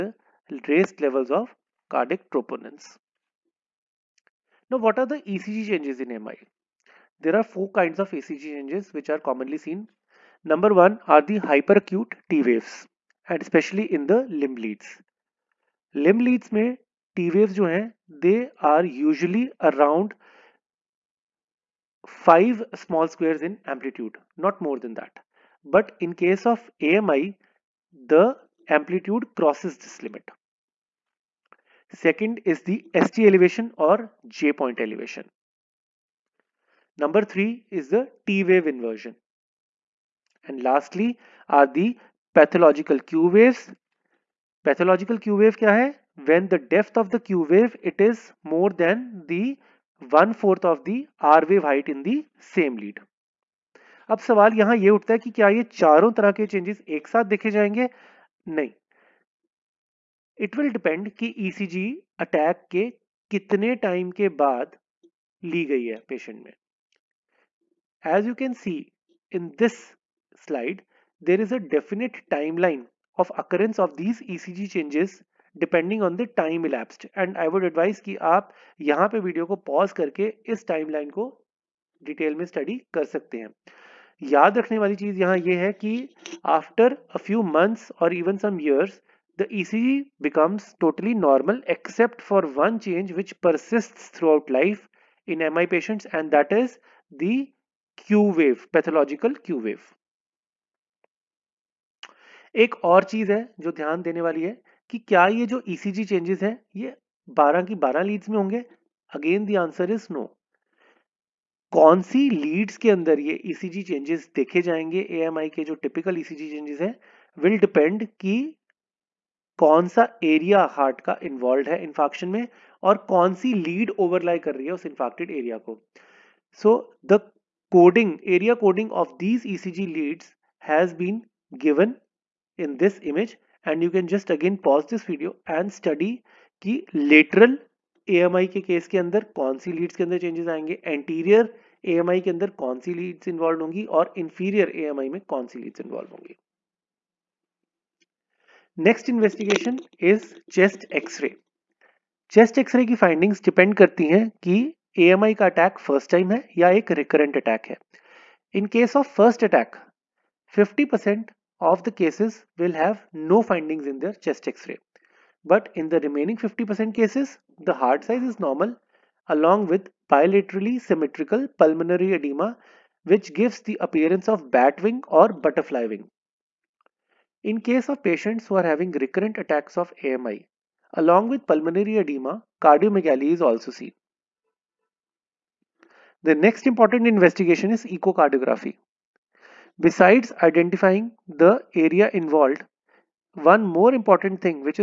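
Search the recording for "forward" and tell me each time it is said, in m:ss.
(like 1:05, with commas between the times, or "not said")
not said.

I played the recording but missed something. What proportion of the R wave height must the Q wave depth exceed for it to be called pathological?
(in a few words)
1/4.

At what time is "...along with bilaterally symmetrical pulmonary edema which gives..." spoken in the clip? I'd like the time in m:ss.
2:49.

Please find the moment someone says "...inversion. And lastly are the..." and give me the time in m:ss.
0:38.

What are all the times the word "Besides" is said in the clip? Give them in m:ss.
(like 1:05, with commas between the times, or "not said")
3:09.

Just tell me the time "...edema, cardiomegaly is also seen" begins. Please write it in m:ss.
3:01.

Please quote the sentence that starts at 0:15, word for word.
Limb leads may T waves जो they are usually around five small squares in amplitude, not more than that.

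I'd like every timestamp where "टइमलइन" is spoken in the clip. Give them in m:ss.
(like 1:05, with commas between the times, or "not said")
1:12, 1:20.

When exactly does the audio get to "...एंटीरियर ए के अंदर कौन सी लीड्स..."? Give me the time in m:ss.
2:20.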